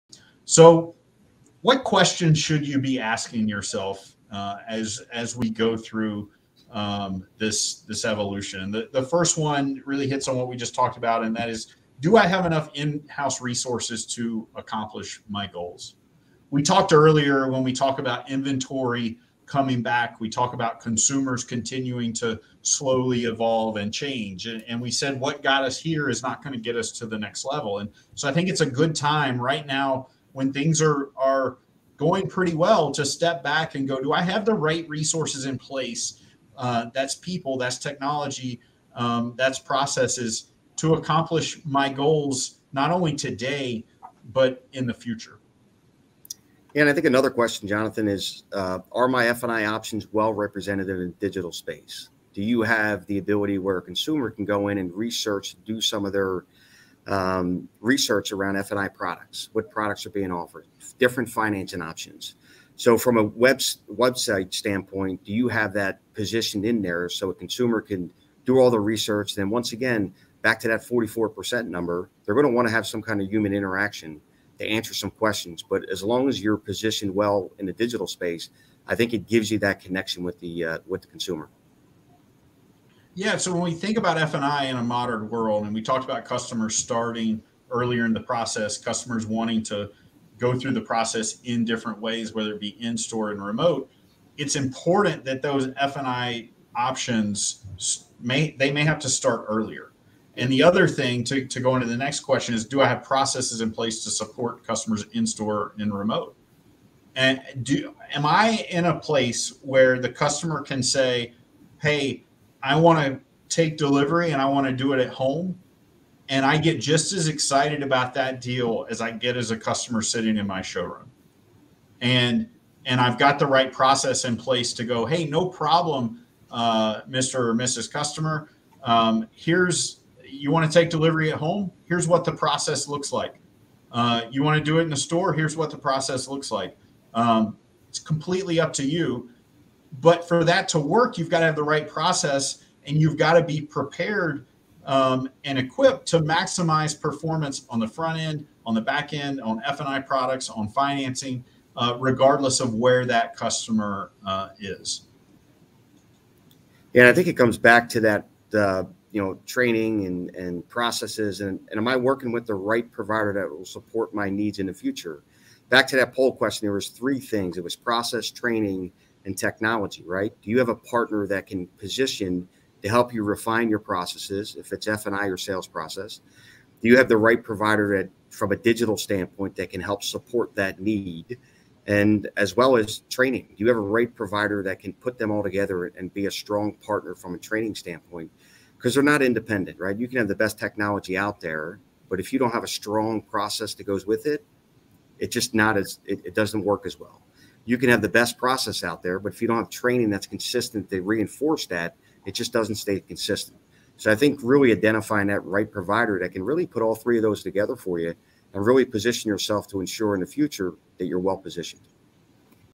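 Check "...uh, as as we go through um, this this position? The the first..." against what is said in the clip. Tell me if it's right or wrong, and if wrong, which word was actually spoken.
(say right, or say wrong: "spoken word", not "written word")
wrong: "evolution", not "position".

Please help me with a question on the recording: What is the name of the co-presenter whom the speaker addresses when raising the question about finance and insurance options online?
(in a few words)
Jonathan.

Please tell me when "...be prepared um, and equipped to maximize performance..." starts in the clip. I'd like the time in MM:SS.
02:23.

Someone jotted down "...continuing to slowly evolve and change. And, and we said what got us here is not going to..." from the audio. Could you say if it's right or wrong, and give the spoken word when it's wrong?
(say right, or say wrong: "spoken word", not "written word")
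right.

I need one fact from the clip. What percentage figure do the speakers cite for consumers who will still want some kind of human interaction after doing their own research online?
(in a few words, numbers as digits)
44%.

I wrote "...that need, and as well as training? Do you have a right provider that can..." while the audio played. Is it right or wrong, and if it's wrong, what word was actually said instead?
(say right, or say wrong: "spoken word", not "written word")
right.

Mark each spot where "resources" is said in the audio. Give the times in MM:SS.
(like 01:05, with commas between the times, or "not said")
00:13, 00:34.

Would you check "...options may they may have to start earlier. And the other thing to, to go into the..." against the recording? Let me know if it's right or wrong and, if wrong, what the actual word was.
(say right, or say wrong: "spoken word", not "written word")
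right.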